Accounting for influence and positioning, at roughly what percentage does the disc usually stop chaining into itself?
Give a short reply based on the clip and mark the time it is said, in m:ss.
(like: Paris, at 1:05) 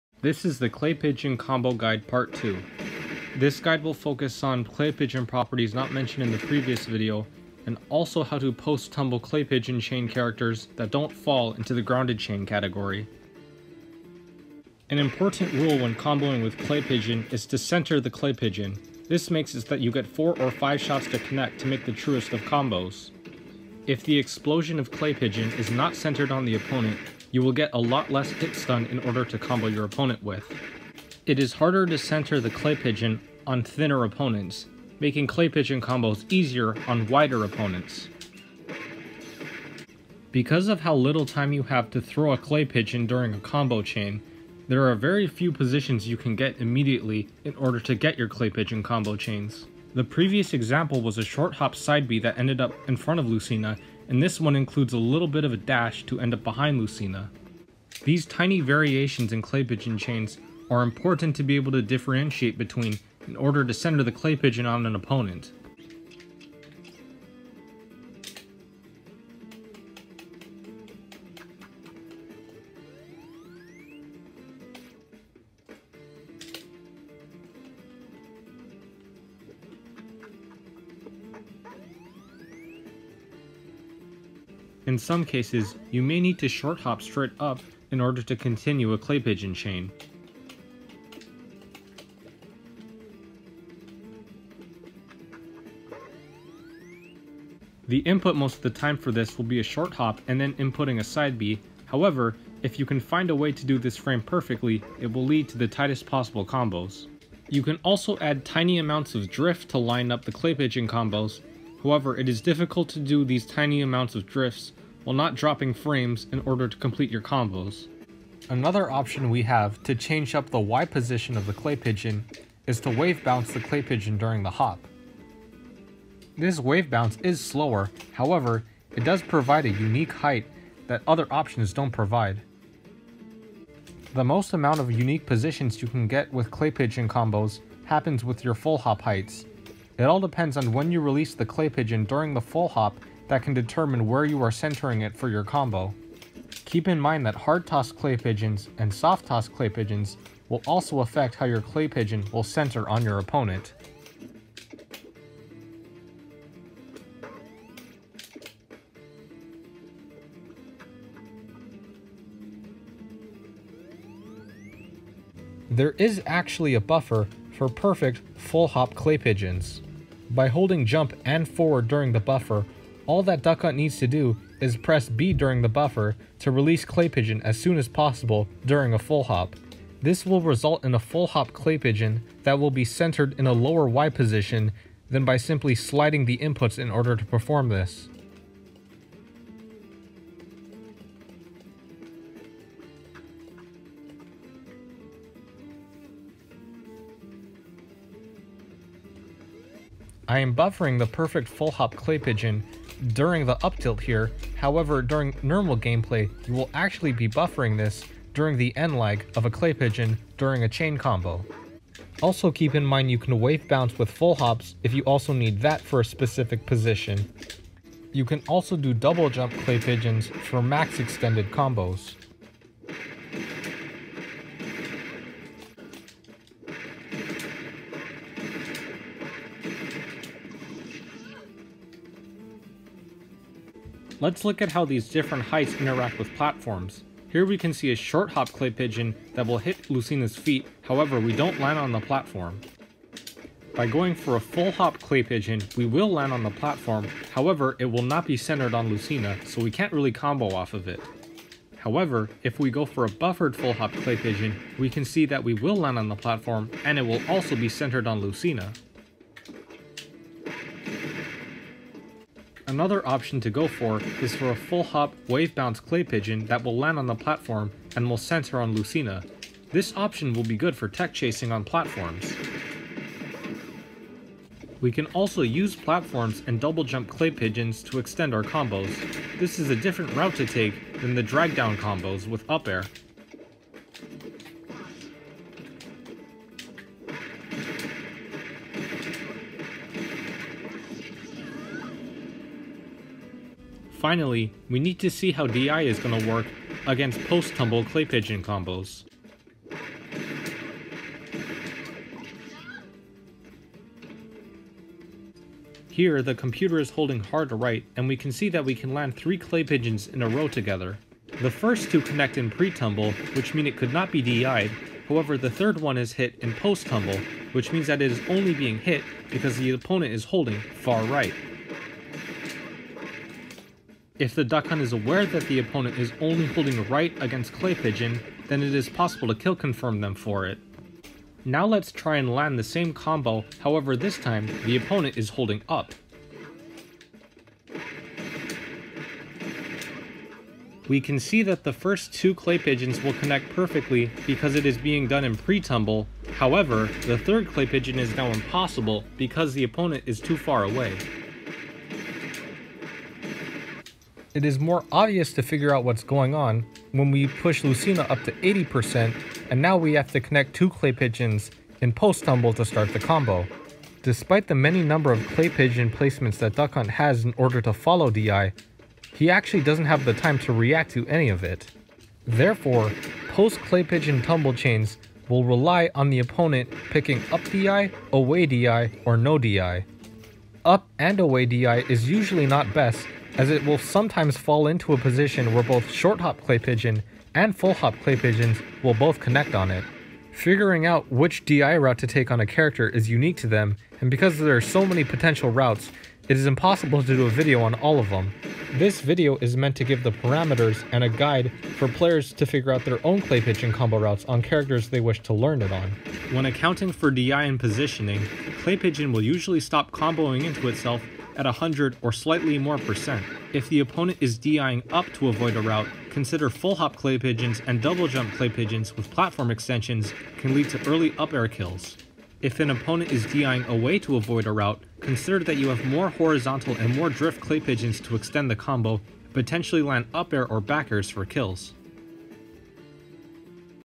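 100, at 6:51.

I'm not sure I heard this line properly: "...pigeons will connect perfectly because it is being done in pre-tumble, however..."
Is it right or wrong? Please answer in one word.
right.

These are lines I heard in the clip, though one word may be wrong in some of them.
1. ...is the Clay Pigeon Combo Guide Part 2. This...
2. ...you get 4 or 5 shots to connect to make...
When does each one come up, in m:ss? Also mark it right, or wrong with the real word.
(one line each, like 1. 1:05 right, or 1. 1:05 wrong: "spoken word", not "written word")
1. 0:00 right
2. 0:19 right.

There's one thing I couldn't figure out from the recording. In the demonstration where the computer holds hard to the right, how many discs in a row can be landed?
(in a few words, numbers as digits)
3.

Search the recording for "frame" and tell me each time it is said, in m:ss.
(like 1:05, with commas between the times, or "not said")
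1:43, 1:55.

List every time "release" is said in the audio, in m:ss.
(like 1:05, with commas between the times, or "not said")
2:20, 2:56.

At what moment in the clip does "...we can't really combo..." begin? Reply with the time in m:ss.
4:09.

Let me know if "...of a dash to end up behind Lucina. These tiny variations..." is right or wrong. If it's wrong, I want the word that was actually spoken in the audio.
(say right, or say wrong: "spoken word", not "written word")
right.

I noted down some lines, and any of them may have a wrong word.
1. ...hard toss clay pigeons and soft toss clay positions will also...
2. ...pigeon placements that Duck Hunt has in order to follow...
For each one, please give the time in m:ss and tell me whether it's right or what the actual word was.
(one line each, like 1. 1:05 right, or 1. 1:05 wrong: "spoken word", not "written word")
1. 2:27 wrong: "pigeons", not "positions"
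2. 6:05 right.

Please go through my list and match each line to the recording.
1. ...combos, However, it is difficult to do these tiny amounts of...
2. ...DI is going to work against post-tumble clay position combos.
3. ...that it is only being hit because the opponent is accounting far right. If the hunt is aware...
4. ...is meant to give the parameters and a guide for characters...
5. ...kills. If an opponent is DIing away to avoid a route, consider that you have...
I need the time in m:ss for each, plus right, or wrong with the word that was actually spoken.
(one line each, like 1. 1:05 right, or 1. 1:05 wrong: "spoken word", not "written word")
1. 1:50 right
2. 4:55 wrong: "pigeon", not "position"
3. 5:17 wrong: "holding", not "accounting"
4. 6:39 wrong: "players", not "characters"
5. 7:01 right.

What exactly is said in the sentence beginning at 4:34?
We can also use platforms and double jump clay pigeons to extend our combos.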